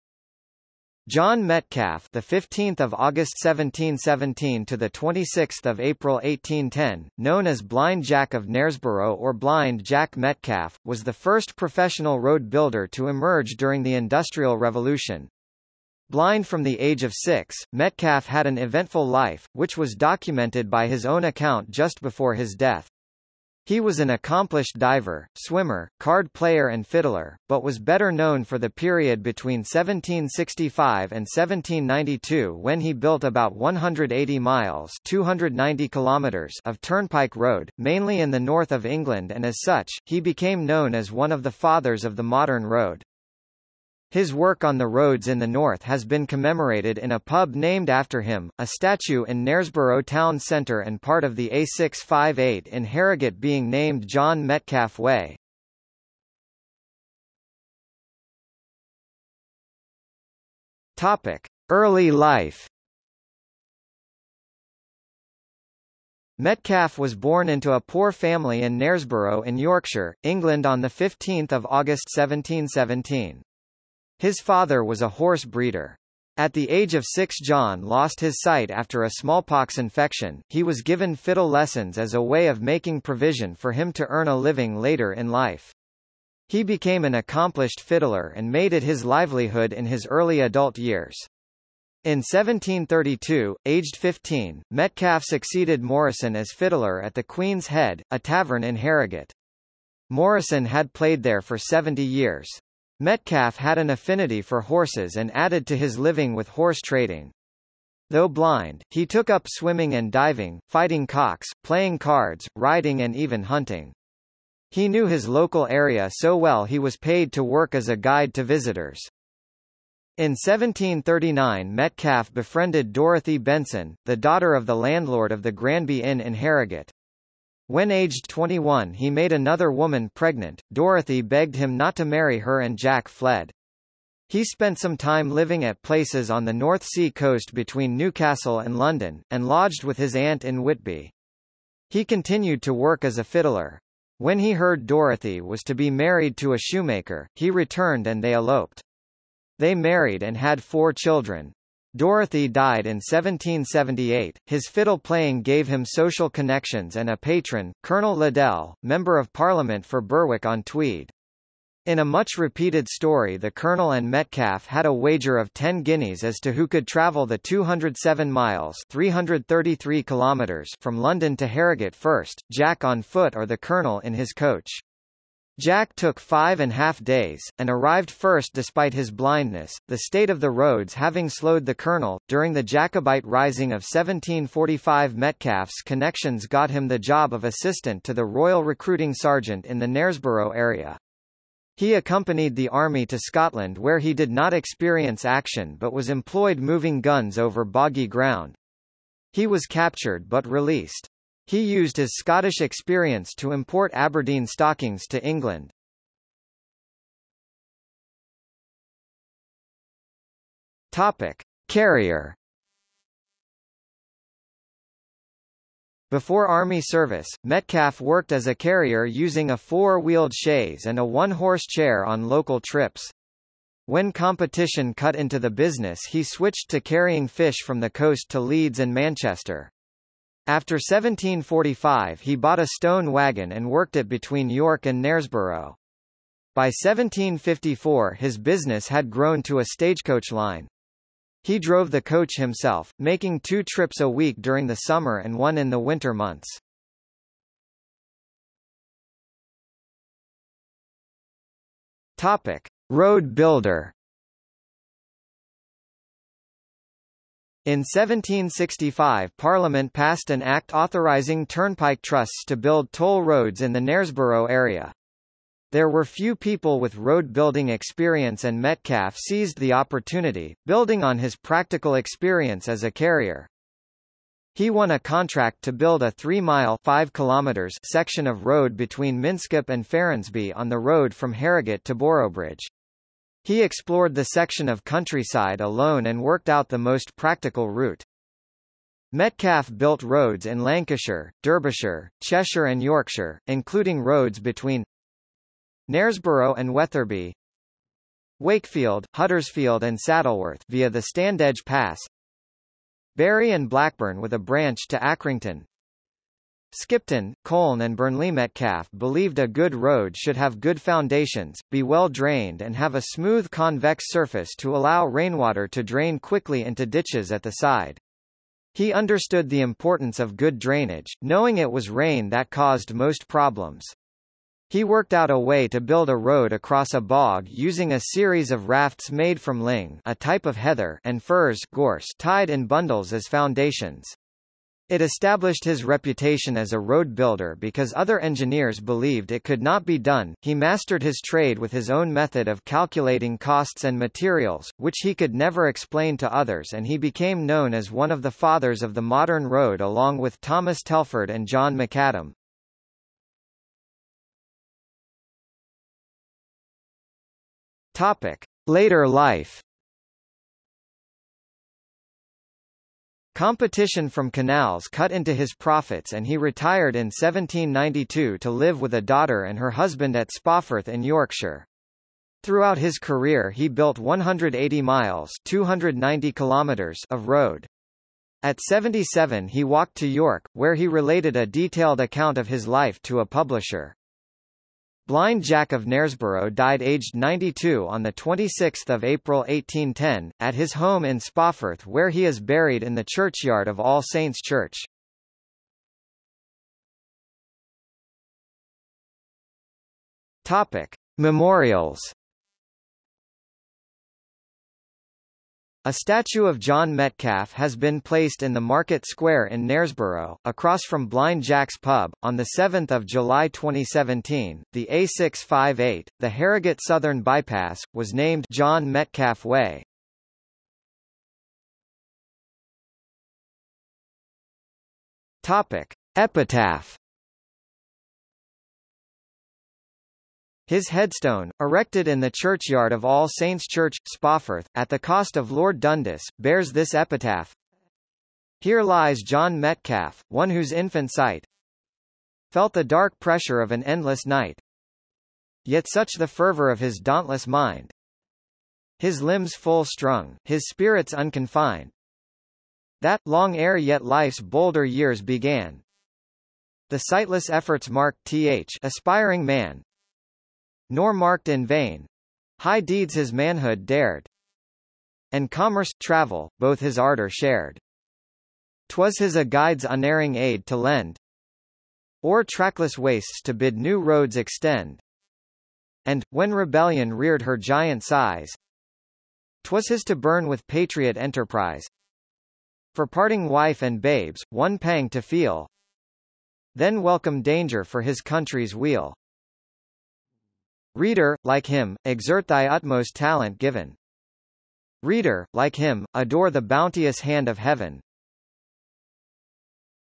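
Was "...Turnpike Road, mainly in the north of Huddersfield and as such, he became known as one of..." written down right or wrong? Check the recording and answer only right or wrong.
wrong.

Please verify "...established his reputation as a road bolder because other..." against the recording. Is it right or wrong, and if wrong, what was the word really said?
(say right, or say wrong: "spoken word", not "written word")
wrong: "builder", not "bolder".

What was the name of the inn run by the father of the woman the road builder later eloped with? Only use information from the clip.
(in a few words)
Granby Inn.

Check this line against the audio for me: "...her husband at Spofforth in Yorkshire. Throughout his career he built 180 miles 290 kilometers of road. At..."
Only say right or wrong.
right.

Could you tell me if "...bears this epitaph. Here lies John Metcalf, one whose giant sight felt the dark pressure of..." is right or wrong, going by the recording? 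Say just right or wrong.
wrong.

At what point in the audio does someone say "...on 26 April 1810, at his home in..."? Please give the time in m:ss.
6:27.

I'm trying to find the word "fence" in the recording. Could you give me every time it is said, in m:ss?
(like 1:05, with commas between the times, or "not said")
not said.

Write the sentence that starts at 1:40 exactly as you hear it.
Morrison had played there for 70 years.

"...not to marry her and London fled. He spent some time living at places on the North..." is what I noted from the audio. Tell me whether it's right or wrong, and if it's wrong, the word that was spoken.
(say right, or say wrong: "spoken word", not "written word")
wrong: "Jack", not "London".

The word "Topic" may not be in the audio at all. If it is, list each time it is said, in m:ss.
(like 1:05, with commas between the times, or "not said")
1:00, 3:30, 4:12, 5:57, 6:40, 7:05.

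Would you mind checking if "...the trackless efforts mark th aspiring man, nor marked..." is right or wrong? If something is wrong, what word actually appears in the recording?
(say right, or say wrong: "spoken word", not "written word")
wrong: "sightless", not "trackless".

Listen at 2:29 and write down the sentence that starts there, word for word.
They married and had four children.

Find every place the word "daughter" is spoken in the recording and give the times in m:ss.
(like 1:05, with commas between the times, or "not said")
2:04, 6:09.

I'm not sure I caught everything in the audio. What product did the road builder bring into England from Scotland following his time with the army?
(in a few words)
Aberdeen stockings.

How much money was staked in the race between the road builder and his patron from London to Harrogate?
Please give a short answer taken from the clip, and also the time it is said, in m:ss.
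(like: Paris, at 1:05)
10 guineas, at 2:45.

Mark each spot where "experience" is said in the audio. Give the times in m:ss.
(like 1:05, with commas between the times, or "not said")
3:14, 3:22, 4:27, 4:31.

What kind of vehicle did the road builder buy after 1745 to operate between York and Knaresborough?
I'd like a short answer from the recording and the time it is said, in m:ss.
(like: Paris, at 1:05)
stone wagon, at 3:52.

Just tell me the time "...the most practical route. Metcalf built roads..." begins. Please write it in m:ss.
4:46.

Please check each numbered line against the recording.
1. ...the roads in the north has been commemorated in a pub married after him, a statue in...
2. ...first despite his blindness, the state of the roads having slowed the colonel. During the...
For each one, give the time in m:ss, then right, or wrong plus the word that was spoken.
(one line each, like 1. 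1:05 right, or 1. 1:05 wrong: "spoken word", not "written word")
1. 0:44 wrong: "named", not "married"
2. 2:58 right.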